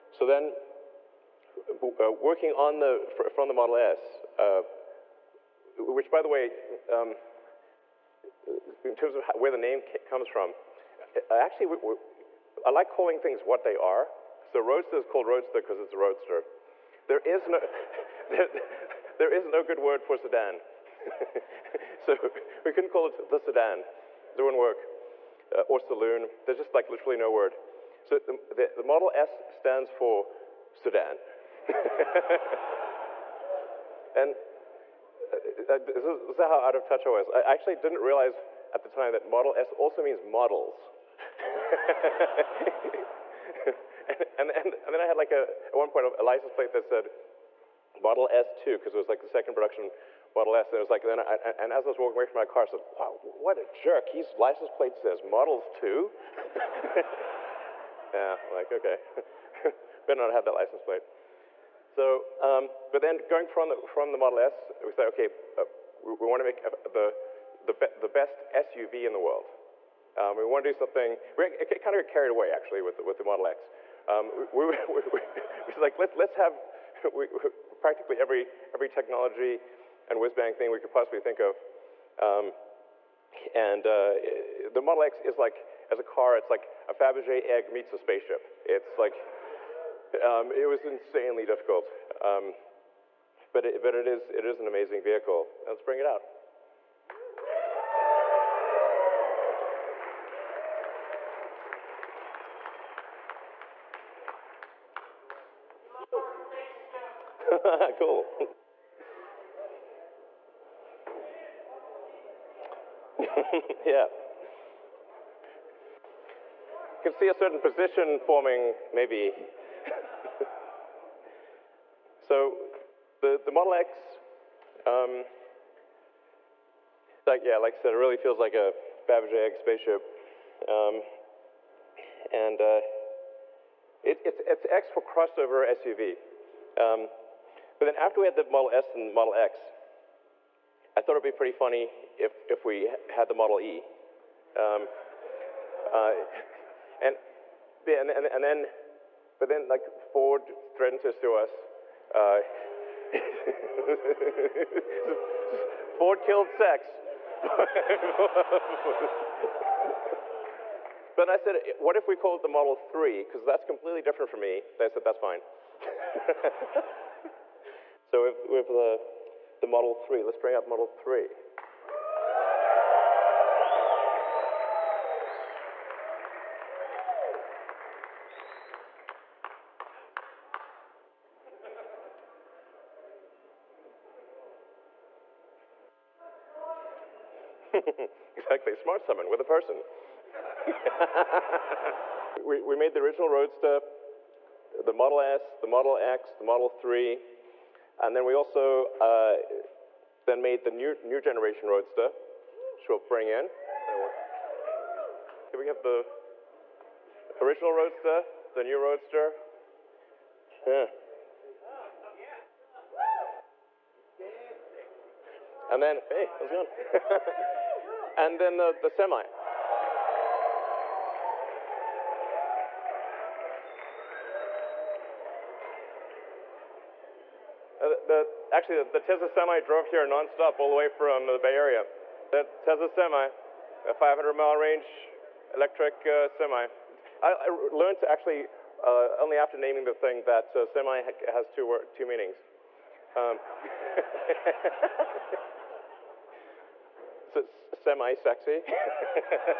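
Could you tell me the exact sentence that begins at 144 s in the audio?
Um, uh, and, yeah, and, and, and, then, but then like Ford threatened to sue us.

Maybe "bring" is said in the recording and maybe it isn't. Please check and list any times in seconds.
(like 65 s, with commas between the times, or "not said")
95 s, 170 s, 202 s.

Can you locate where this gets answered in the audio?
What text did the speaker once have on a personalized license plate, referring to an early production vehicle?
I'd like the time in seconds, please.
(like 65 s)
47 s.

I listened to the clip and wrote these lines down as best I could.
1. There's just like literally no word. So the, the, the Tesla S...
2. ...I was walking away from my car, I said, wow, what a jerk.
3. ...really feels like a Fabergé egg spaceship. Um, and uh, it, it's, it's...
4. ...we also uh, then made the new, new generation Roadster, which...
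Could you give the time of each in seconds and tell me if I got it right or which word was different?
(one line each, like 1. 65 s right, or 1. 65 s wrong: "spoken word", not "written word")
1. 26 s wrong: "Model", not "Tesla"
2. 51 s right
3. 127 s right
4. 198 s right.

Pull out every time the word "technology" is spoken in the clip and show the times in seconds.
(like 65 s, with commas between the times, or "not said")
78 s.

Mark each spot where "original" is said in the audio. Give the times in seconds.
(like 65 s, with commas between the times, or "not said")
192 s, 207 s.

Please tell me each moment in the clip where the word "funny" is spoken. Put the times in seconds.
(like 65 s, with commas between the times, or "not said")
141 s.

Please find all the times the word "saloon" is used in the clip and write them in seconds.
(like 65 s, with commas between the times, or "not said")
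25 s.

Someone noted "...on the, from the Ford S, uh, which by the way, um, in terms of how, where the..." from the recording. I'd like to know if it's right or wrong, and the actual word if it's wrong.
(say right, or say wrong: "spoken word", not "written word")
wrong: "Model", not "Ford".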